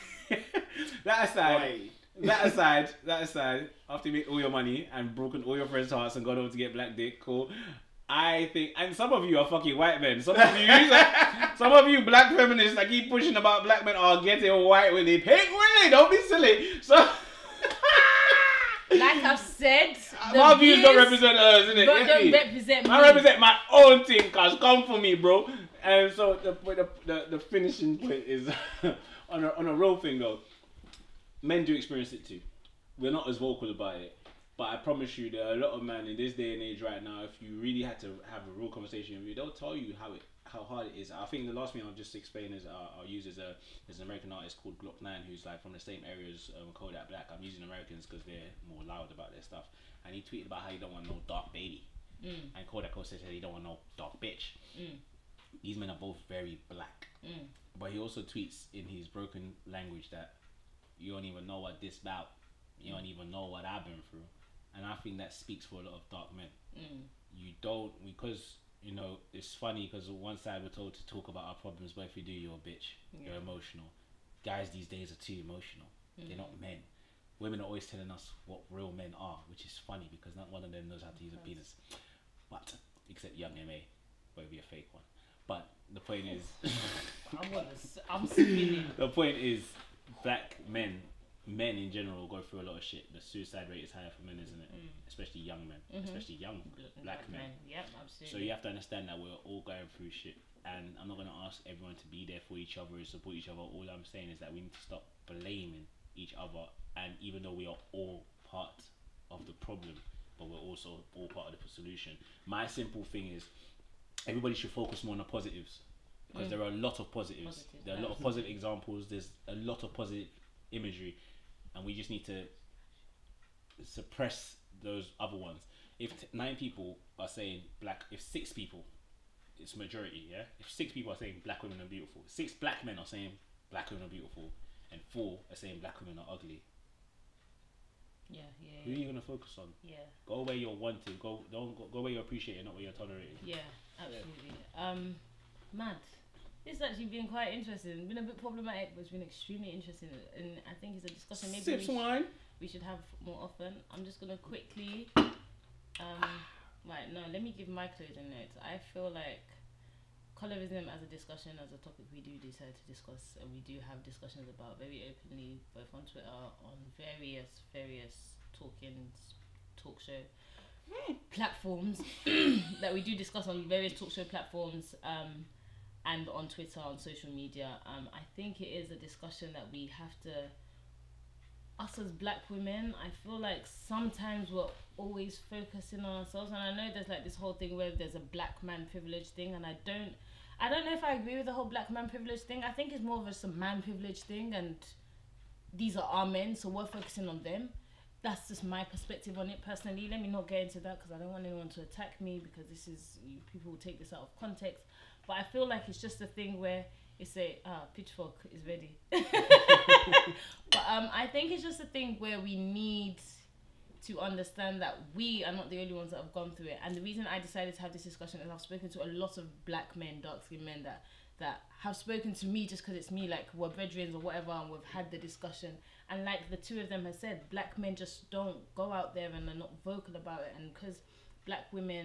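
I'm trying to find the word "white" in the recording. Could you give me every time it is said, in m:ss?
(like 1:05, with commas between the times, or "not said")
0:09, 0:14.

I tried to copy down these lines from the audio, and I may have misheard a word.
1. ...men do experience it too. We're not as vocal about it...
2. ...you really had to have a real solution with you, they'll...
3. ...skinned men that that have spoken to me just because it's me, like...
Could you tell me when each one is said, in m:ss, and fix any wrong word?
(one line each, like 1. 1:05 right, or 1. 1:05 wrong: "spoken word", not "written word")
1. 0:31 right
2. 0:37 wrong: "conversation", not "solution"
3. 3:40 right.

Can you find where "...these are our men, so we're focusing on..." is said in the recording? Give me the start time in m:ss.
3:15.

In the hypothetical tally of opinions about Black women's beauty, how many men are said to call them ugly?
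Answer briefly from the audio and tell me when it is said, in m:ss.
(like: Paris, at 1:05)
4, at 2:15.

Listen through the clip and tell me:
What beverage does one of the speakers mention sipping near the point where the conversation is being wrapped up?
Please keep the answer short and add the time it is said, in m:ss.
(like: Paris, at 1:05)
Wine, at 2:31.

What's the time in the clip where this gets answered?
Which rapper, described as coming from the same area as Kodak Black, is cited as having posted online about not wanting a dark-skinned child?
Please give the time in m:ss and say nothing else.
0:44.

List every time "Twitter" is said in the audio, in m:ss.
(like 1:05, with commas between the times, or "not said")
2:46, 2:56.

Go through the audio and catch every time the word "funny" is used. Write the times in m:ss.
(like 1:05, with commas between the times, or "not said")
1:09, 1:19.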